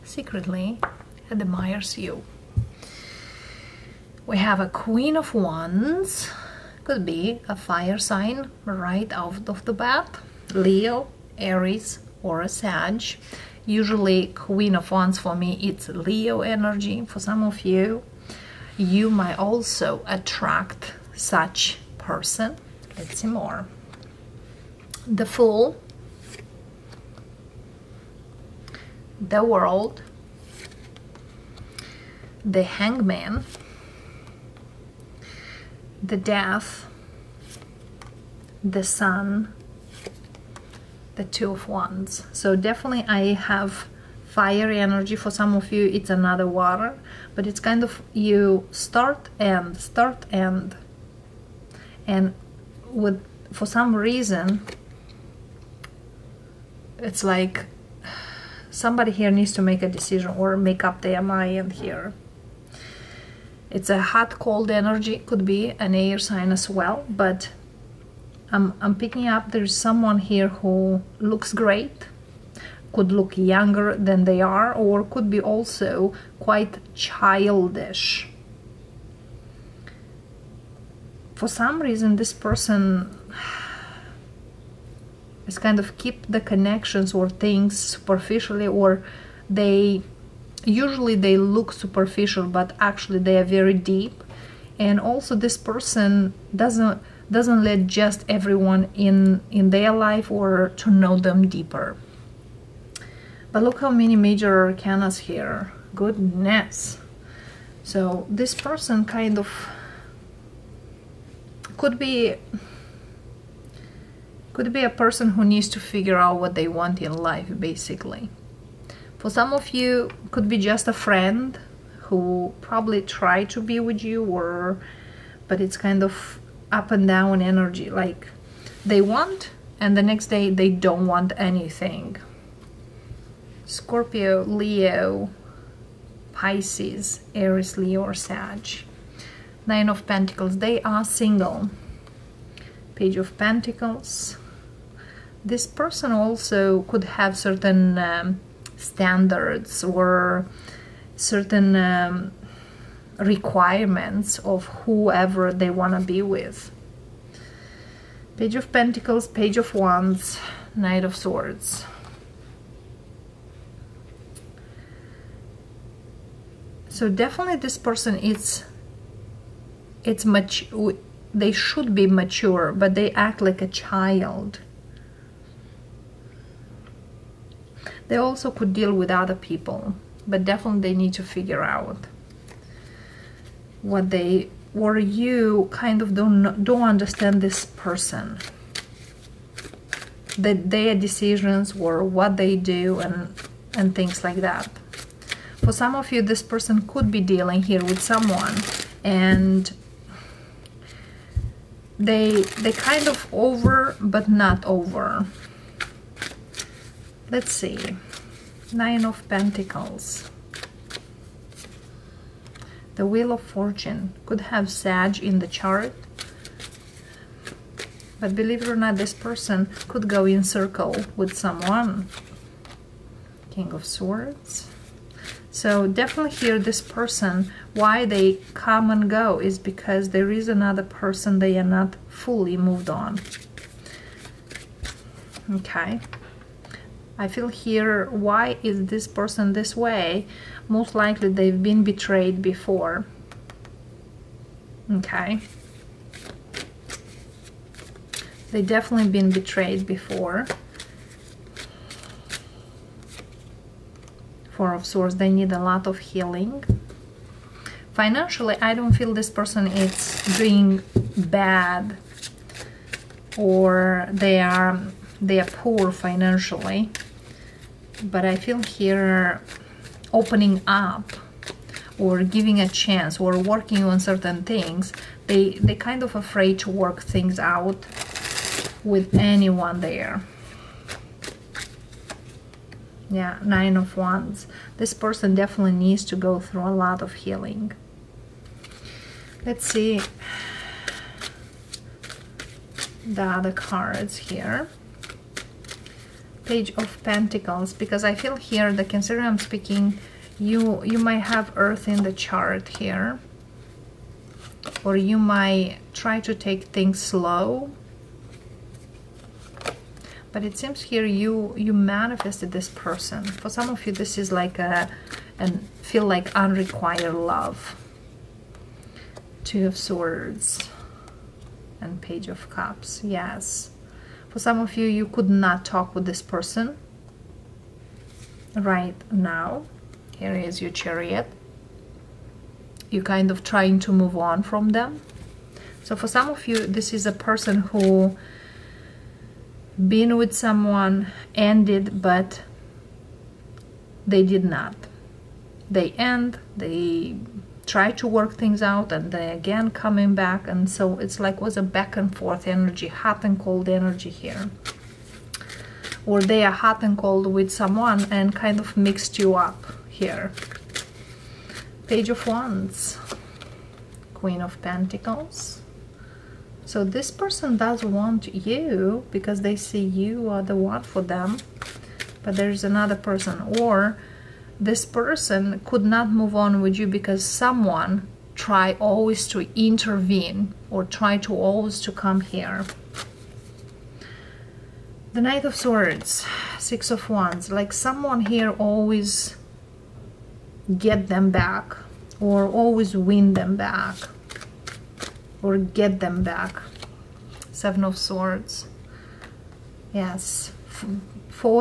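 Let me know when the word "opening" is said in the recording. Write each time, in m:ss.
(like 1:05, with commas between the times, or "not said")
4:30.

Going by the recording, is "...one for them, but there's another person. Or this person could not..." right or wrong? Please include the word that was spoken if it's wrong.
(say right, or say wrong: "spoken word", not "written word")
right.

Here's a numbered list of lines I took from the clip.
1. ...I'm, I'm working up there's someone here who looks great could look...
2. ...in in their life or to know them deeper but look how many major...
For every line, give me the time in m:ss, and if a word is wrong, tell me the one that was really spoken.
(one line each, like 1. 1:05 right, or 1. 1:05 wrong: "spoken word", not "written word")
1. 1:08 wrong: "picking", not "working"
2. 1:38 right.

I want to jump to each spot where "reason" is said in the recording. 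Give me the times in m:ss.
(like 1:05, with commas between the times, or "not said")
0:53, 1:21.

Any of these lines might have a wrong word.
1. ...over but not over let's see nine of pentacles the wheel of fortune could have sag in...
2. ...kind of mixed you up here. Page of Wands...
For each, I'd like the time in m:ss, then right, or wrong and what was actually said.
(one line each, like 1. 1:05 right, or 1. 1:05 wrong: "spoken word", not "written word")
1. 3:23 right
2. 5:58 right.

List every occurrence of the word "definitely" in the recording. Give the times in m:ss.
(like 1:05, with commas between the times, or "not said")
0:42, 2:47, 3:00, 3:45, 4:08, 4:45.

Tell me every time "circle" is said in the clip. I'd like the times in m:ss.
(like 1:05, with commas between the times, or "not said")
3:40.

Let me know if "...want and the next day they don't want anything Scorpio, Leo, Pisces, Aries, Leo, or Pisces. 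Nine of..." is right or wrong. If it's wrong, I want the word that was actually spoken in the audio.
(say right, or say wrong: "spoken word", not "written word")
wrong: "Sag", not "Pisces".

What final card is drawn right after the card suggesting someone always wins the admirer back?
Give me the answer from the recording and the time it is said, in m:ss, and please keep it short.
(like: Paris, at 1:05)
Seven of Swords, at 6:37.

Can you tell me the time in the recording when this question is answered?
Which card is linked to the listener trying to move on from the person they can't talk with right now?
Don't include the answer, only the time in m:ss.
5:30.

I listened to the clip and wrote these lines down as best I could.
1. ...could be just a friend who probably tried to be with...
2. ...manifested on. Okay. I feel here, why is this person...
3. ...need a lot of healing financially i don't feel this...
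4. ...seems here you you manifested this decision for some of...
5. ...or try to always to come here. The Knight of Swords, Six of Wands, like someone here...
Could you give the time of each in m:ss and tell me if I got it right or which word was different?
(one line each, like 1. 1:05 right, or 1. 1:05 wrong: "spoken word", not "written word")
1. 2:00 right
2. 3:52 wrong: "moved", not "manifested"
3. 4:15 right
4. 5:10 wrong: "person", not "decision"
5. 6:20 right.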